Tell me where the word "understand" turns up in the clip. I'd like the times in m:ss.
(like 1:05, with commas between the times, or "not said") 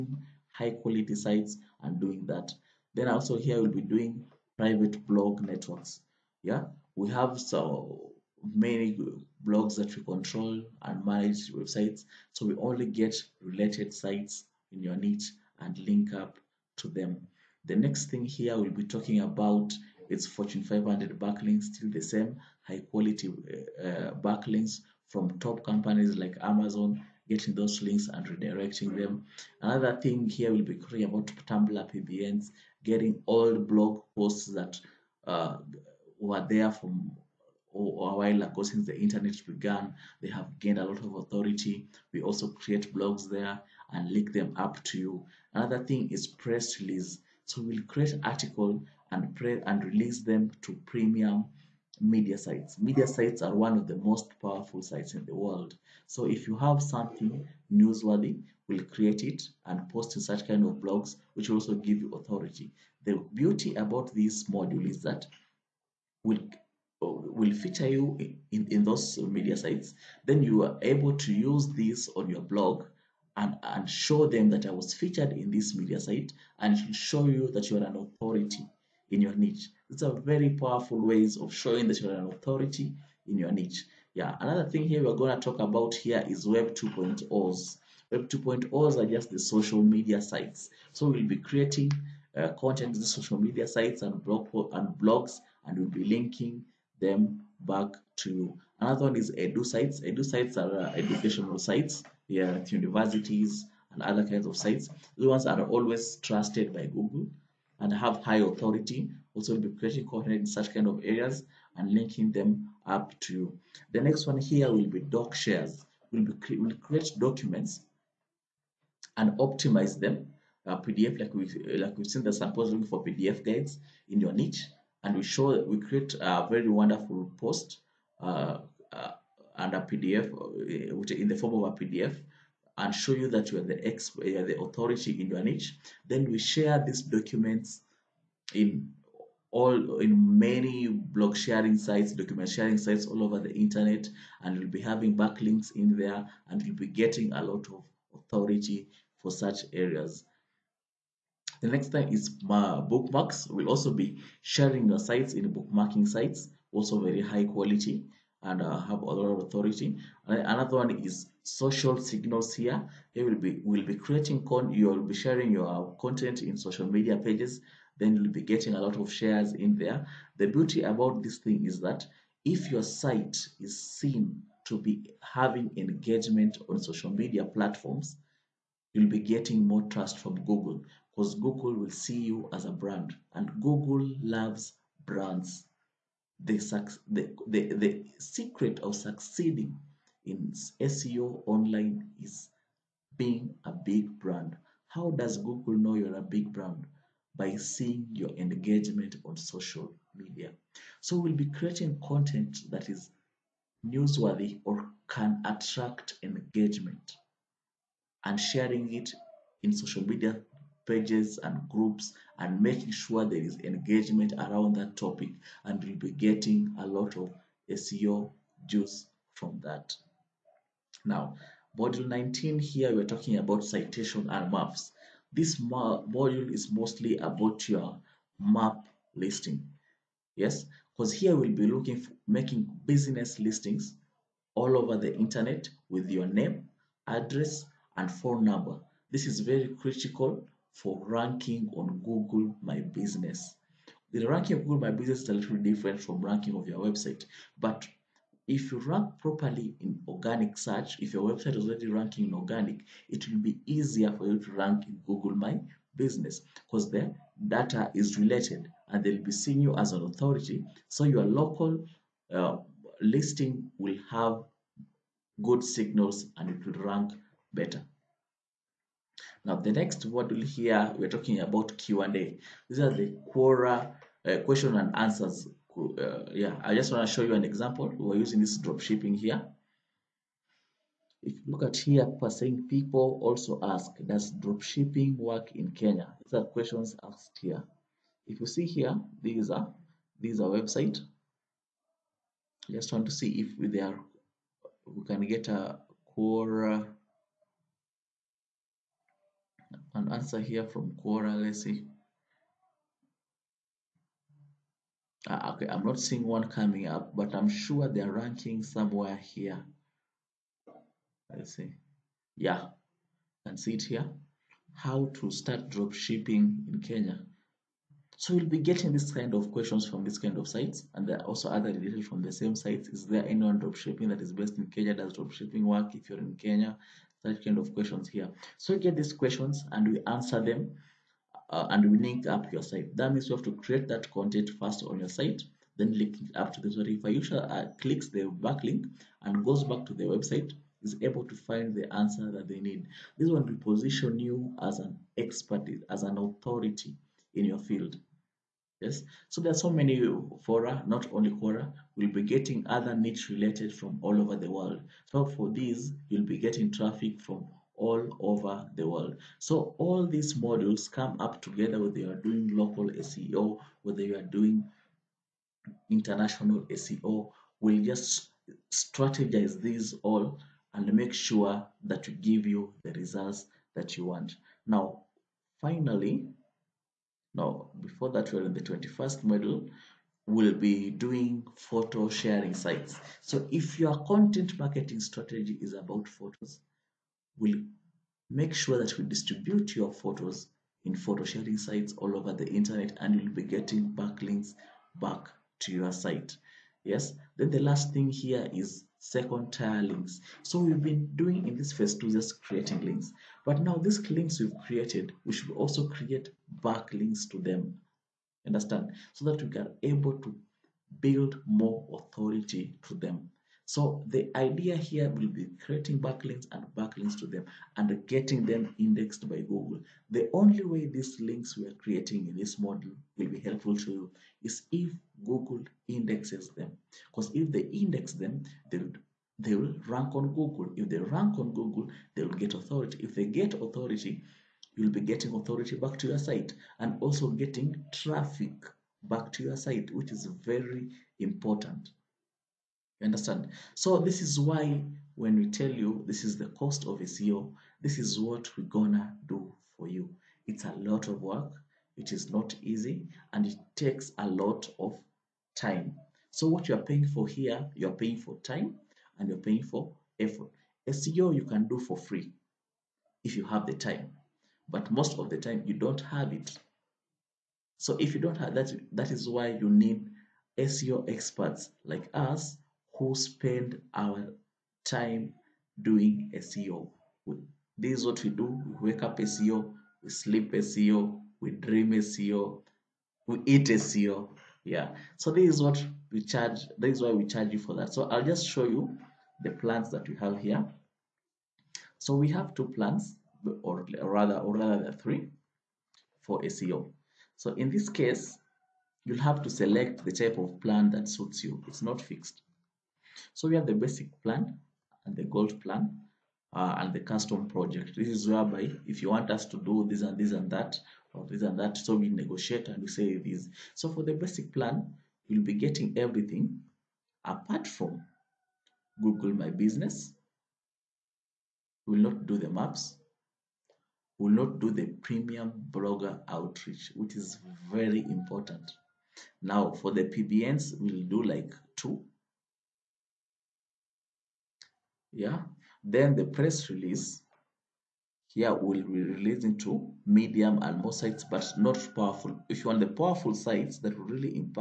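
6:48, 7:23.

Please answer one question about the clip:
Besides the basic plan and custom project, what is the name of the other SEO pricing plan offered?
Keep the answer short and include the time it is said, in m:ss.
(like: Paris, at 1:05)
Gold plan, at 8:25.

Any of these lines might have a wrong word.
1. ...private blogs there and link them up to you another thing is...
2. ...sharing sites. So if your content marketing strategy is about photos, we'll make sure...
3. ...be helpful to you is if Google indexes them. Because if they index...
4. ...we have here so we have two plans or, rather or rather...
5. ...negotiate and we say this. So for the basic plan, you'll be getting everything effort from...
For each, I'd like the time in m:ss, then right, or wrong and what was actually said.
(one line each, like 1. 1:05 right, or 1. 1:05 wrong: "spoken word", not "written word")
1. 0:42 wrong: "create", not "private"
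2. 6:22 right
3. 7:03 right
4. 8:10 right
5. 8:32 wrong: "apart", not "effort".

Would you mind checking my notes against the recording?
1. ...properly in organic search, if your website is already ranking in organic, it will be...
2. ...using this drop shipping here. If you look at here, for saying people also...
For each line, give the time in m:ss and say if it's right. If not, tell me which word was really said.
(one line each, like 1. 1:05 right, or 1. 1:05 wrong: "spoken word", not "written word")
1. 4:09 right
2. 4:38 right.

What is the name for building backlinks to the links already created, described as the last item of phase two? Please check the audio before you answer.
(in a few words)
Second tier links.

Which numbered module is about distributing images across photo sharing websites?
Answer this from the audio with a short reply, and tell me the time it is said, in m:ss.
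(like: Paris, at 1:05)
21st, at 6:18.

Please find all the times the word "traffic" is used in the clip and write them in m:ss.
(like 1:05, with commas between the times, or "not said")
5:56, 7:17.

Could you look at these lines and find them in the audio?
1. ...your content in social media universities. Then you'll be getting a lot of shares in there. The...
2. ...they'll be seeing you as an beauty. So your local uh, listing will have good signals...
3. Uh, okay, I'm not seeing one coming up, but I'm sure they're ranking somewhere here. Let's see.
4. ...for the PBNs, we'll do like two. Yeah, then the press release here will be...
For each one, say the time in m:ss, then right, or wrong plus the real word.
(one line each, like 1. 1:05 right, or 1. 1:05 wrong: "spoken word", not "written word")
1. 2:45 wrong: "pages", not "universities"
2. 4:19 wrong: "authority", not "beauty"
3. 5:05 right
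4. 8:49 right.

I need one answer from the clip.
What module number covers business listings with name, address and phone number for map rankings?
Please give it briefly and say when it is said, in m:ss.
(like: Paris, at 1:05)
19, at 3:41.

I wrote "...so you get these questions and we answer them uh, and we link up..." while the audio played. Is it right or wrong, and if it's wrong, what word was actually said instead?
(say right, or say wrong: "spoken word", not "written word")
right.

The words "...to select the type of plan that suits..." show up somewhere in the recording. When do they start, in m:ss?
8:19.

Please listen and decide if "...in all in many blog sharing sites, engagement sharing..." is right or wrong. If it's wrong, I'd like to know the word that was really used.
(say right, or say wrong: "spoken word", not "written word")
wrong: "document", not "engagement".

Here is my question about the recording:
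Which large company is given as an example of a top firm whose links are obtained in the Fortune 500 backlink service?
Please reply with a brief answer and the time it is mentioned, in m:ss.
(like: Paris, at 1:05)
Amazon, at 0:26.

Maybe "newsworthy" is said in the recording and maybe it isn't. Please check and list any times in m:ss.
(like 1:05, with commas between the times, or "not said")
0:57, 3:23.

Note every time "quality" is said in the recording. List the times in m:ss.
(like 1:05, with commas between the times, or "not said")
0:00, 0:22, 2:37.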